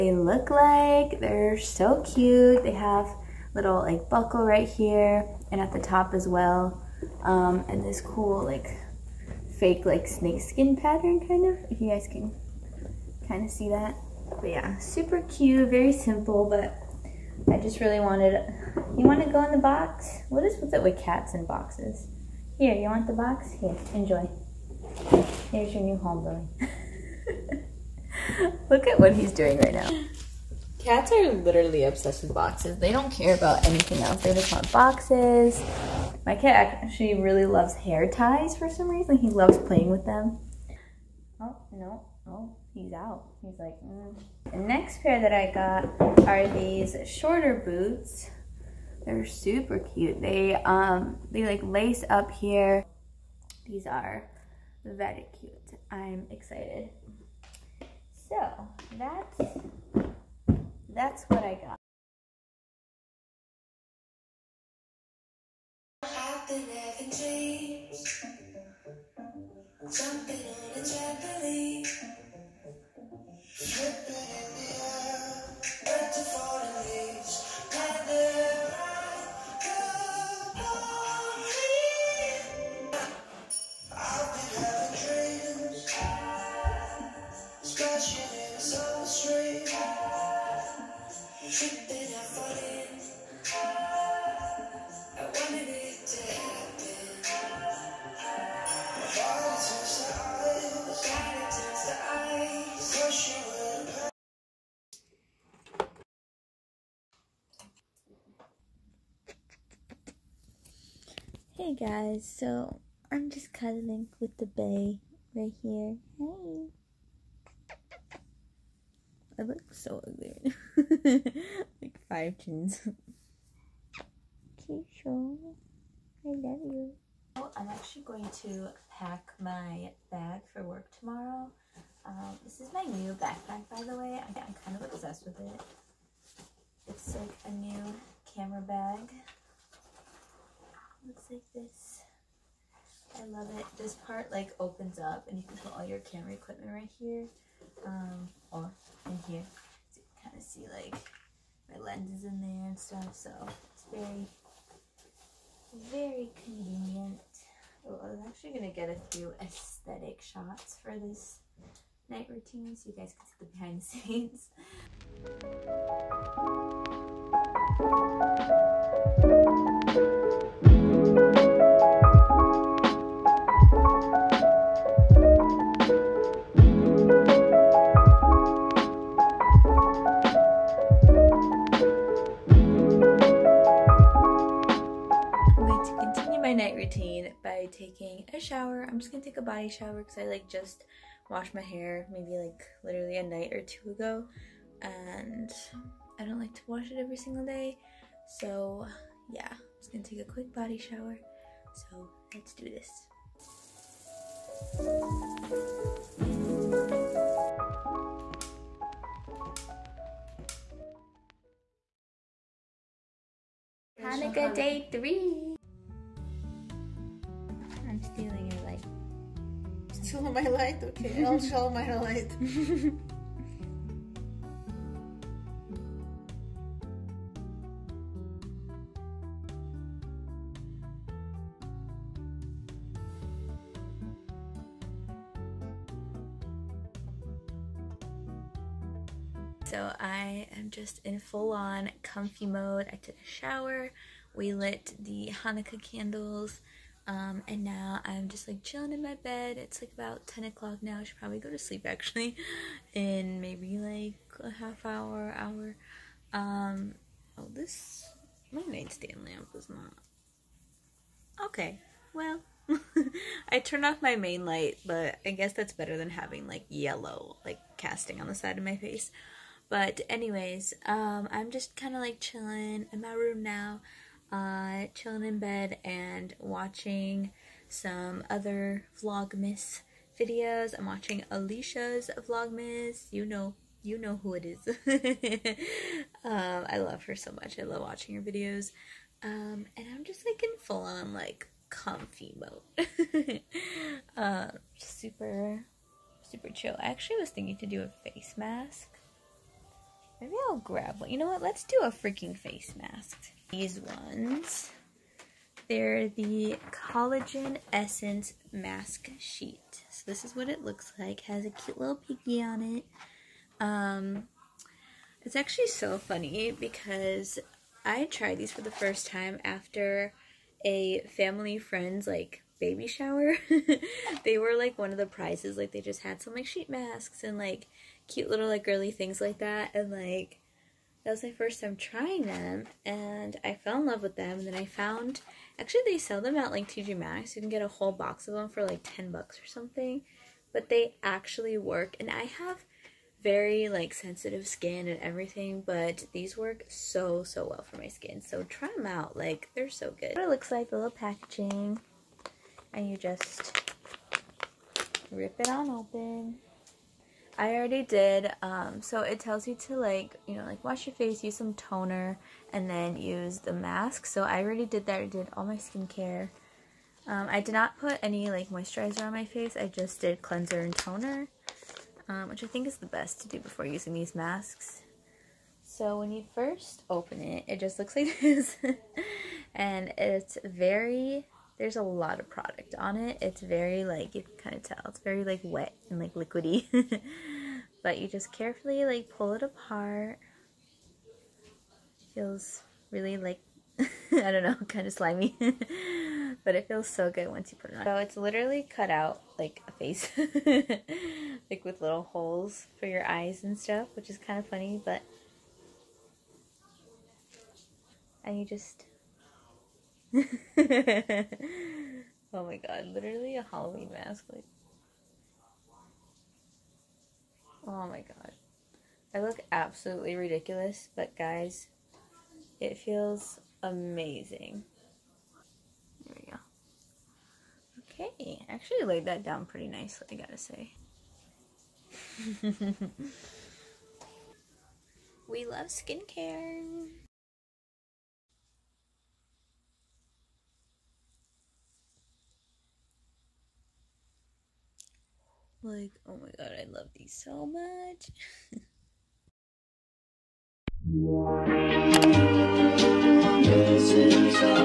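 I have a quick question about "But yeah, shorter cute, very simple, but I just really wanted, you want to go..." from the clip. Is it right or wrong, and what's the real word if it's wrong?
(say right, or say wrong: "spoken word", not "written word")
wrong: "super", not "shorter".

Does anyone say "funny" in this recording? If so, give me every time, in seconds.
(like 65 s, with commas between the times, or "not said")
315 s, 404 s.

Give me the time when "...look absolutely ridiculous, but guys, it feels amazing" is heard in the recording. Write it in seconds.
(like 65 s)
419 s.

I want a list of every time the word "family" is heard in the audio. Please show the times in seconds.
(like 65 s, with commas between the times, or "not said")
321 s.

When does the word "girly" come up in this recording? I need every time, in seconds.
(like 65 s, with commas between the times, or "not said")
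328 s.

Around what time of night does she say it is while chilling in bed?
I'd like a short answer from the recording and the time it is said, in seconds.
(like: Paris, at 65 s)
10 o'clock, at 250 s.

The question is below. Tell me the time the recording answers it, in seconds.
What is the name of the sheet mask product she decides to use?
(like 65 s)
306 s.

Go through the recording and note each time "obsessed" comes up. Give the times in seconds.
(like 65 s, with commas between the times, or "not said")
31 s, 134 s.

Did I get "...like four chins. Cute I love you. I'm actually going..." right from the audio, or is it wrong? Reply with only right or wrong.
wrong.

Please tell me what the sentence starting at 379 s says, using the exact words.
and it's very there's a lot of product on it.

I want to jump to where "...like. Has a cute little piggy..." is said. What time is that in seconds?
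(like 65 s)
310 s.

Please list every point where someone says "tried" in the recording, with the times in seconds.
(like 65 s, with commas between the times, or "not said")
318 s.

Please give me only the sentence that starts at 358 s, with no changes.
Um, so it tells you to like, you know, like wash your face, use some toner, and then use the mask.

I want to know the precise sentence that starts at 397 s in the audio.
So it's literally cut out like a face.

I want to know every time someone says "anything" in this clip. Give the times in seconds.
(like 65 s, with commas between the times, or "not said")
33 s.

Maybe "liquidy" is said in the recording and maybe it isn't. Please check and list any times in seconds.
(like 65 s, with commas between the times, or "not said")
386 s.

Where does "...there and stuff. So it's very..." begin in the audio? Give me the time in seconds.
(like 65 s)
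152 s.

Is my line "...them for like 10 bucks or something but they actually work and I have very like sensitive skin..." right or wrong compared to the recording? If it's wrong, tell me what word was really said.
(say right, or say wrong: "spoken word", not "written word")
right.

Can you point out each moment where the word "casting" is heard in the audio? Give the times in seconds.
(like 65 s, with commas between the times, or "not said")
267 s.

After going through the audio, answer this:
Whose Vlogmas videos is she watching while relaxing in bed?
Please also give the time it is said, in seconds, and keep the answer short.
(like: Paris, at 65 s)
Alicia, at 281 s.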